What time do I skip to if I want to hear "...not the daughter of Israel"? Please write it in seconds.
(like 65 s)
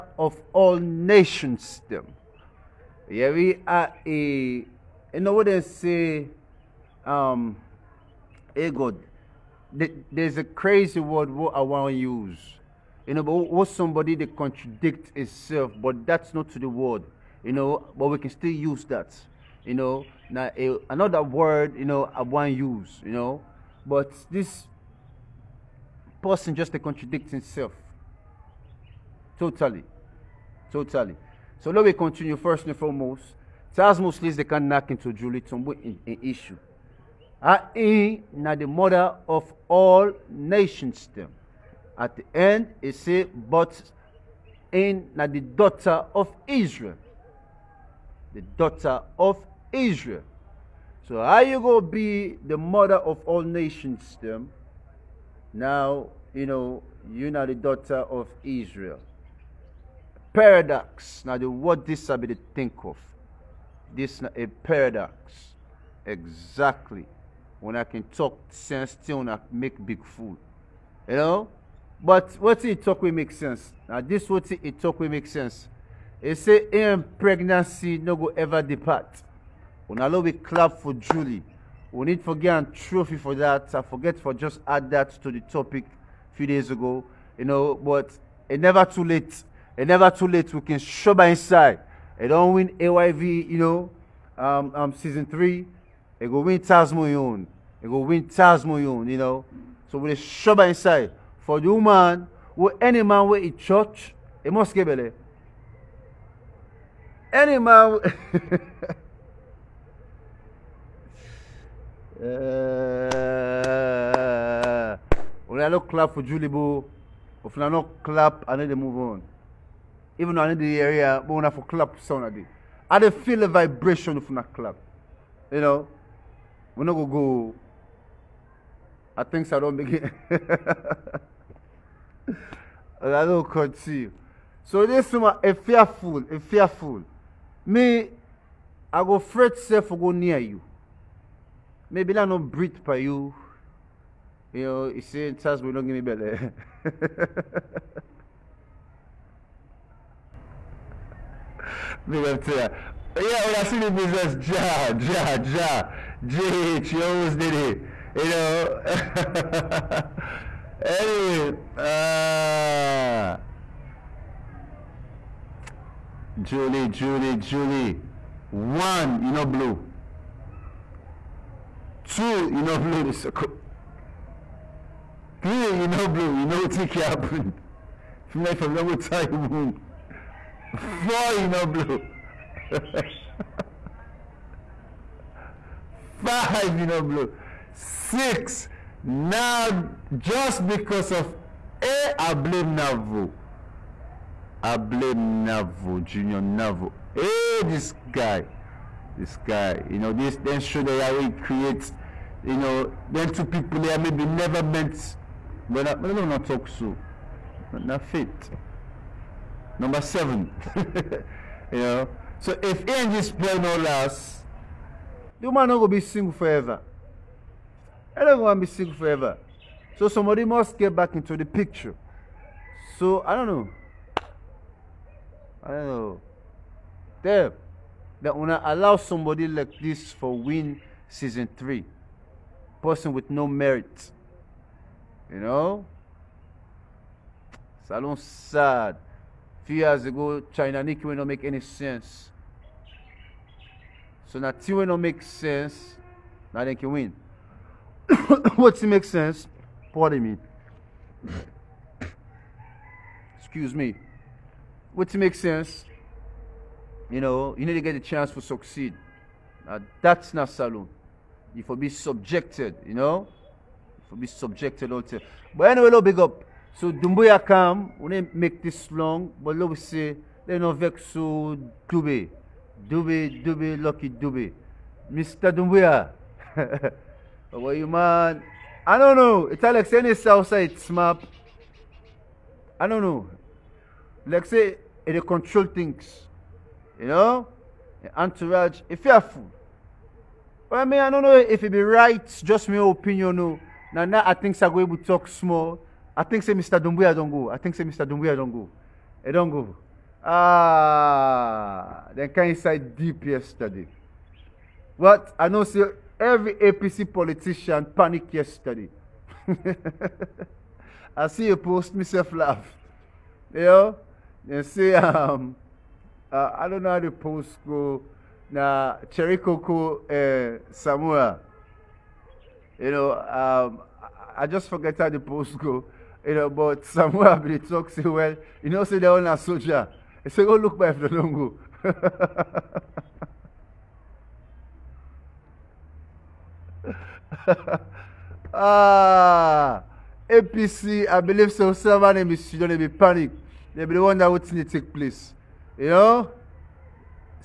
57 s.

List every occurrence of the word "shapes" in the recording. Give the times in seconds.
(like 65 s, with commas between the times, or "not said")
not said.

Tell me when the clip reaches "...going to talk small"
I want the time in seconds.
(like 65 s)
294 s.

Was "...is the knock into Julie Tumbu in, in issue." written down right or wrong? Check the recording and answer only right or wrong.
right.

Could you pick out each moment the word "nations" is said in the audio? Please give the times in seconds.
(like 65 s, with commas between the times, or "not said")
0 s, 40 s, 53 s.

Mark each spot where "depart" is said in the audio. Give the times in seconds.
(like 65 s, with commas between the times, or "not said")
78 s.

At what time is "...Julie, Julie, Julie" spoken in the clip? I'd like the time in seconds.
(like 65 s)
166 s.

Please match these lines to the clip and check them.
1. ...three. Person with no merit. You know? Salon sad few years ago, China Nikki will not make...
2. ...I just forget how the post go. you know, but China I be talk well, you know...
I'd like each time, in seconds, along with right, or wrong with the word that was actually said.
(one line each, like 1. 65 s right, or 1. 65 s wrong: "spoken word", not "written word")
1. 231 s right
2. 324 s wrong: "Samuel", not "China".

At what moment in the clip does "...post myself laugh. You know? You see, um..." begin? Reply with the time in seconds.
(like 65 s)
311 s.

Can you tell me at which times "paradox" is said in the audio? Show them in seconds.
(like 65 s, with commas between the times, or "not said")
60 s, 64 s.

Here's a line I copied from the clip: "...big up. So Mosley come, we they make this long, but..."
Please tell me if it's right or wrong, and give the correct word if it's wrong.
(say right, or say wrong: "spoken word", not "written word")
wrong: "Doumbouya", not "Mosley".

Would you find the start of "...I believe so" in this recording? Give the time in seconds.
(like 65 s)
341 s.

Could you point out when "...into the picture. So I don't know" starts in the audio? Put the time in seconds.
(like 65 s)
221 s.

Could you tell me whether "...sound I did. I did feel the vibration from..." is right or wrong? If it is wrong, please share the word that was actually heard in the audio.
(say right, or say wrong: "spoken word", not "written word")
right.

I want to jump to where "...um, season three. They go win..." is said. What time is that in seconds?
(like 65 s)
94 s.